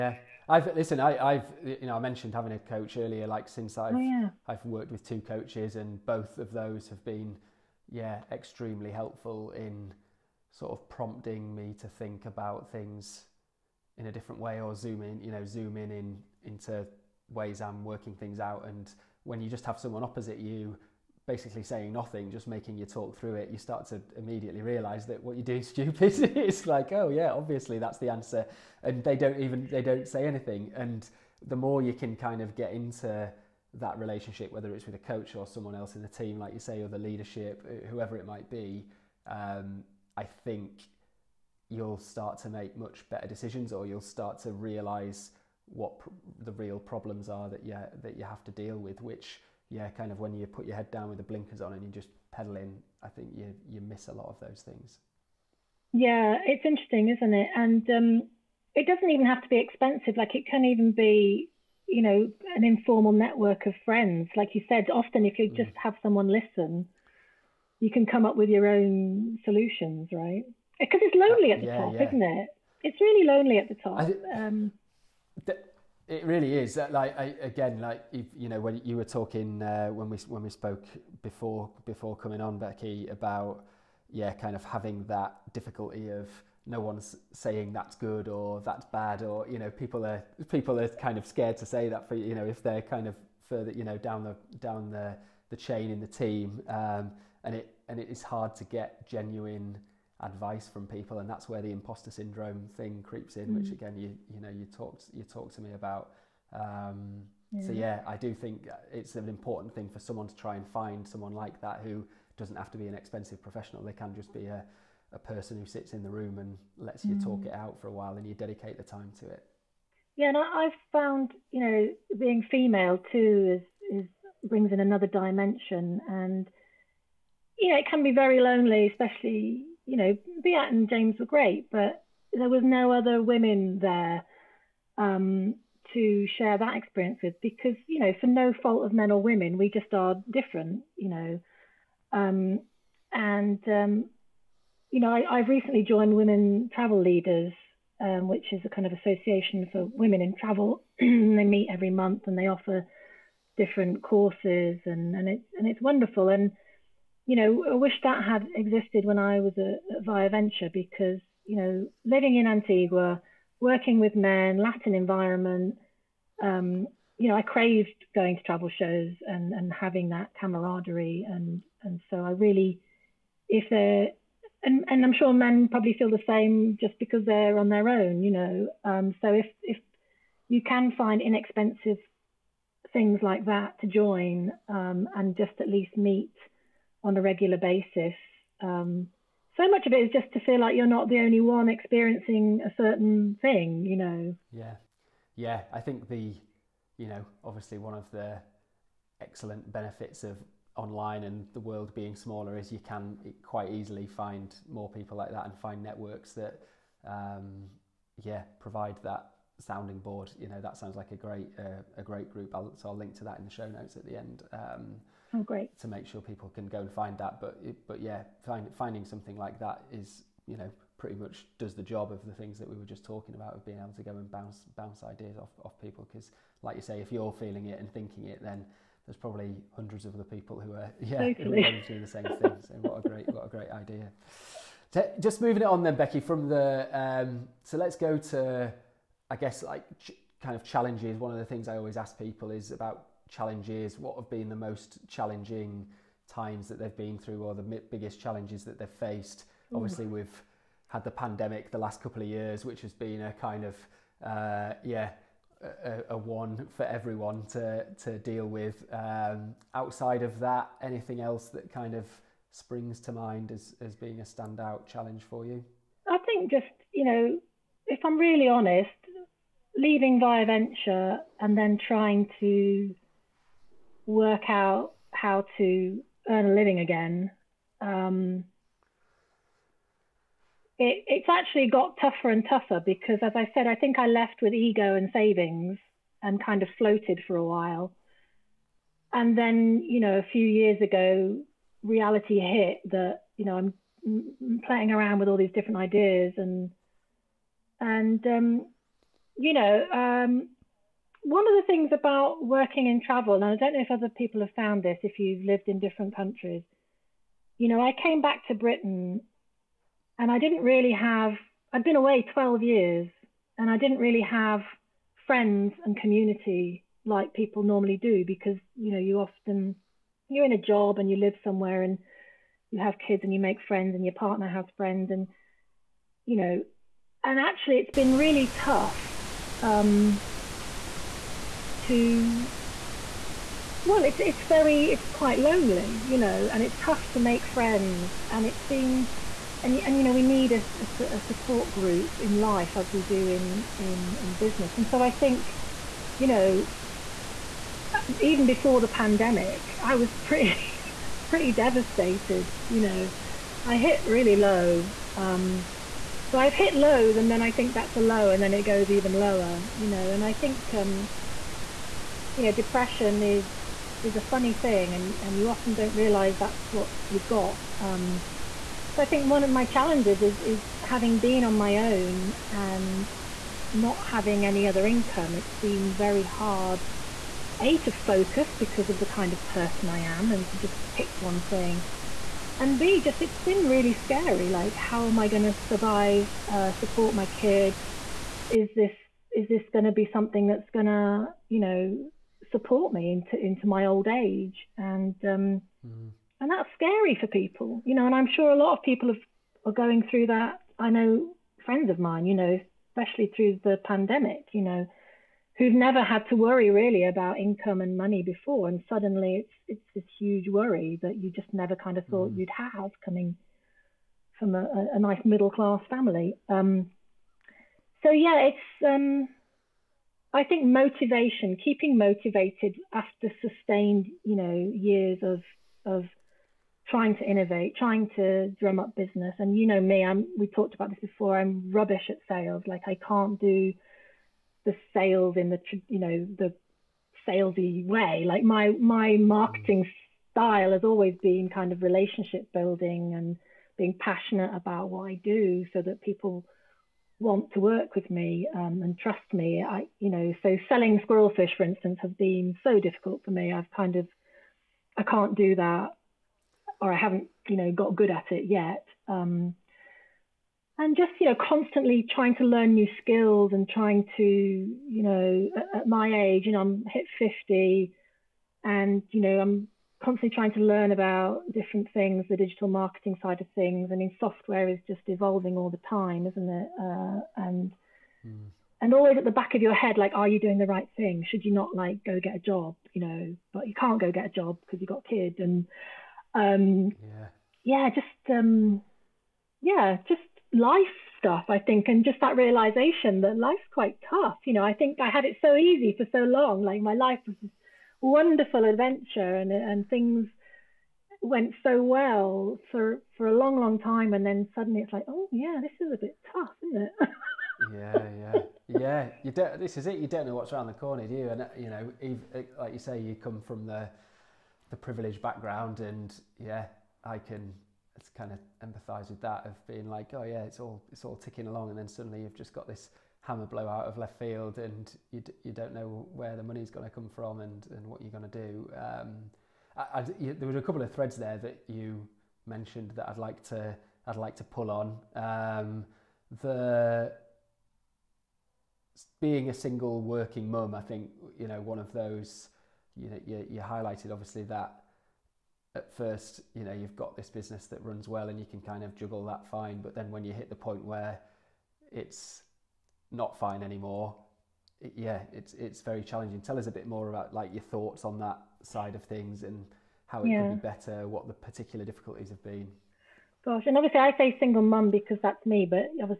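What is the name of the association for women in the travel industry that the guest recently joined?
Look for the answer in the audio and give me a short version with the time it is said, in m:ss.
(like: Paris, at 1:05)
Women Travel Leaders, at 2:26.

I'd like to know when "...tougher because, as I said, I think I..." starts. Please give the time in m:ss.
4:42.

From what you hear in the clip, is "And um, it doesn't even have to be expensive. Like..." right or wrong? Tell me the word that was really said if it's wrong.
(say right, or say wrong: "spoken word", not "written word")
right.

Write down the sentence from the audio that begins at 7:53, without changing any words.
I mean, software is just evolving all the time, isn't it?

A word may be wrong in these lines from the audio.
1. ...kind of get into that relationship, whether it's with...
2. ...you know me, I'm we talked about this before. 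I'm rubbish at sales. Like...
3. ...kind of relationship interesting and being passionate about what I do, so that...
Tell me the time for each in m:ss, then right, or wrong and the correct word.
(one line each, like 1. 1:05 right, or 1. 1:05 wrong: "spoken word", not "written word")
1. 0:32 right
2. 7:09 right
3. 7:21 wrong: "building", not "interesting".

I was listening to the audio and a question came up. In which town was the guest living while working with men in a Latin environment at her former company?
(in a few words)
Antigua.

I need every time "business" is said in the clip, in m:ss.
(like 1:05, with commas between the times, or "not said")
5:44, 7:08, 9:07.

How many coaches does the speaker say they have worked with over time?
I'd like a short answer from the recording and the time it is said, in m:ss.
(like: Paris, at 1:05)
2, at 0:05.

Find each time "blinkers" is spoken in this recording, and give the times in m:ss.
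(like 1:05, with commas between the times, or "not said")
0:51.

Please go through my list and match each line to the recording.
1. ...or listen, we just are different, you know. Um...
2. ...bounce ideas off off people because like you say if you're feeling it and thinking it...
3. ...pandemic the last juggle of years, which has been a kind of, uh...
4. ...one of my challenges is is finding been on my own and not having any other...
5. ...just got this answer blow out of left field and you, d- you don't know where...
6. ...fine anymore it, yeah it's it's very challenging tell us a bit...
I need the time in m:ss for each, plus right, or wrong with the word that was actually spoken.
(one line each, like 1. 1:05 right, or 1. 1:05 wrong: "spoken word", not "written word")
1. 2:19 wrong: "women", not "listen"
2. 3:44 right
3. 4:11 wrong: "couple", not "juggle"
4. 6:09 wrong: "having", not "finding"
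5. 8:42 wrong: "hammer", not "answer"
6. 9:13 right.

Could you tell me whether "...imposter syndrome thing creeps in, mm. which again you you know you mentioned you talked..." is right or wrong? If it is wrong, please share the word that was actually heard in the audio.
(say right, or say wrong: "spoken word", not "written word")
wrong: "talked", not "mentioned".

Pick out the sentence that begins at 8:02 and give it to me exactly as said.
You know, but you can't go get a job because you've got a kid.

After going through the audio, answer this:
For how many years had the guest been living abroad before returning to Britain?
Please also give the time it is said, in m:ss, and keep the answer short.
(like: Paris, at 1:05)
12, at 5:12.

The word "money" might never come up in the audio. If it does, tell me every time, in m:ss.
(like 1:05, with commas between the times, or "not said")
6:47, 8:46.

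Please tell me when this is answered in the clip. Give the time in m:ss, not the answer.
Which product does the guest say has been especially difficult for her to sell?
7:30.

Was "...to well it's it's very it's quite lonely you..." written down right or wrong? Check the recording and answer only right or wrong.
right.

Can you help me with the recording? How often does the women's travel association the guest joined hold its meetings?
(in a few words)
Every month.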